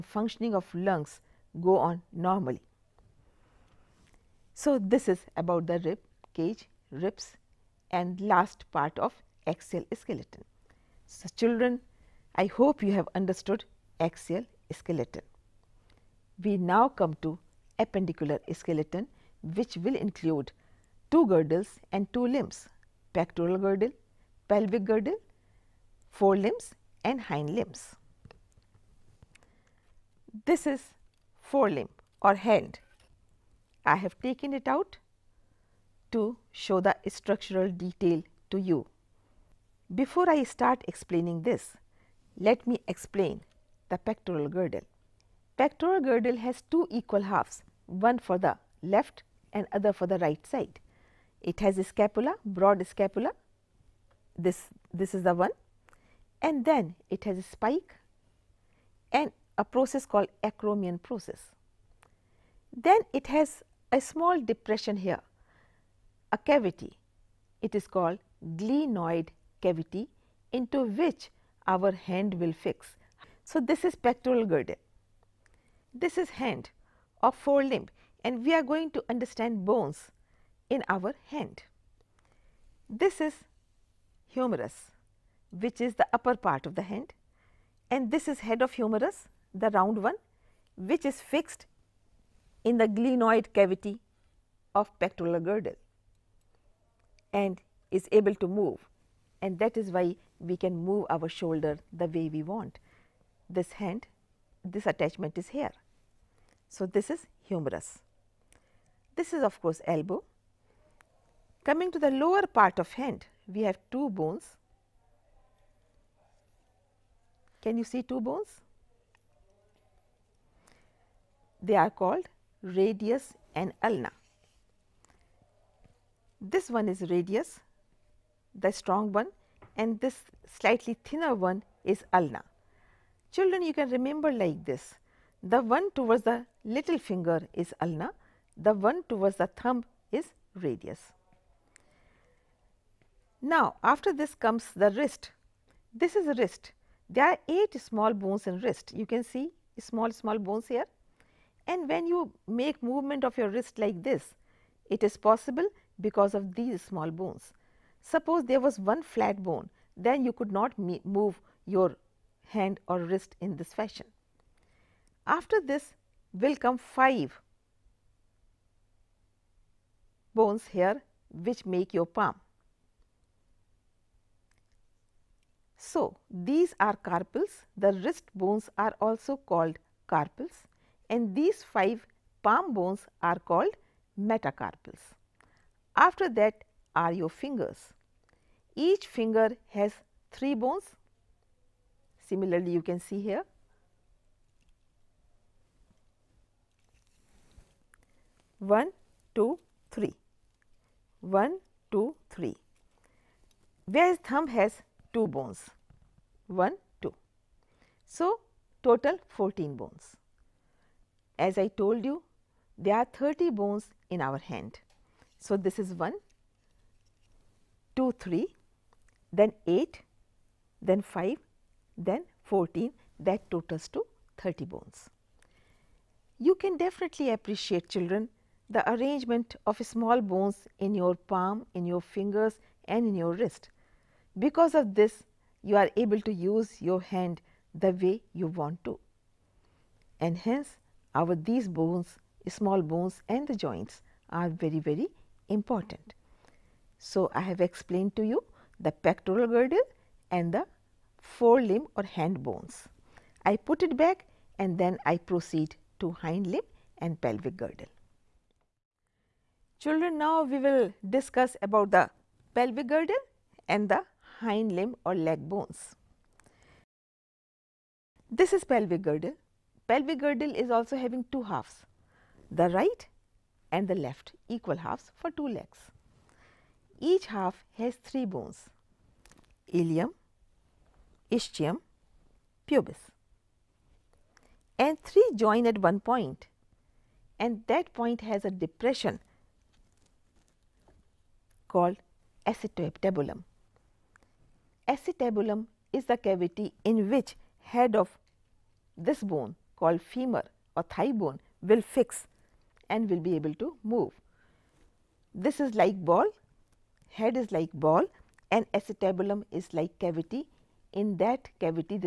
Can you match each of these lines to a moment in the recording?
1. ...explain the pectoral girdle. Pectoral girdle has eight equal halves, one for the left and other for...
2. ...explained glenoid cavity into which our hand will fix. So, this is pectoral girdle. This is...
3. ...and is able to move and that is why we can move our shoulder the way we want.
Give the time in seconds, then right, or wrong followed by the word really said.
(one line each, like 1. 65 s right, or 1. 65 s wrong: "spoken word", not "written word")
1. 42 s wrong: "two", not "eight"
2. 67 s wrong: "called", not "explained"
3. 97 s right.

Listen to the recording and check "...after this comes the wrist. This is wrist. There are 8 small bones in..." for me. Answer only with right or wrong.
right.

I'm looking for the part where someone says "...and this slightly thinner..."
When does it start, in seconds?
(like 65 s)
129 s.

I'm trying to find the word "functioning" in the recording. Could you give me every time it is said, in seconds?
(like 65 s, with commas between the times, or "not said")
0 s.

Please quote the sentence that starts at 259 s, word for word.
Children, now we will discuss about the pelvic girdle and the hind limb or leg bones.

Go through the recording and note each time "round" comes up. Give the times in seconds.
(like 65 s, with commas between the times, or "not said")
89 s.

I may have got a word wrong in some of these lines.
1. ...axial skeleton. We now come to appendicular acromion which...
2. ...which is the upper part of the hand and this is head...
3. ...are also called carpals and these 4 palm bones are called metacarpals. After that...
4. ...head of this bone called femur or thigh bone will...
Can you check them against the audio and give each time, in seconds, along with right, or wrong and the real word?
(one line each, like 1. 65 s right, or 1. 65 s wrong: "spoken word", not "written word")
1. 13 s wrong: "skeleton", not "acromion"
2. 85 s right
3. 178 s wrong: "5", not "4"
4. 297 s right.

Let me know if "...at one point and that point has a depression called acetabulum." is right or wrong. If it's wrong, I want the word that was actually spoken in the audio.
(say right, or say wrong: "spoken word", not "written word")
right.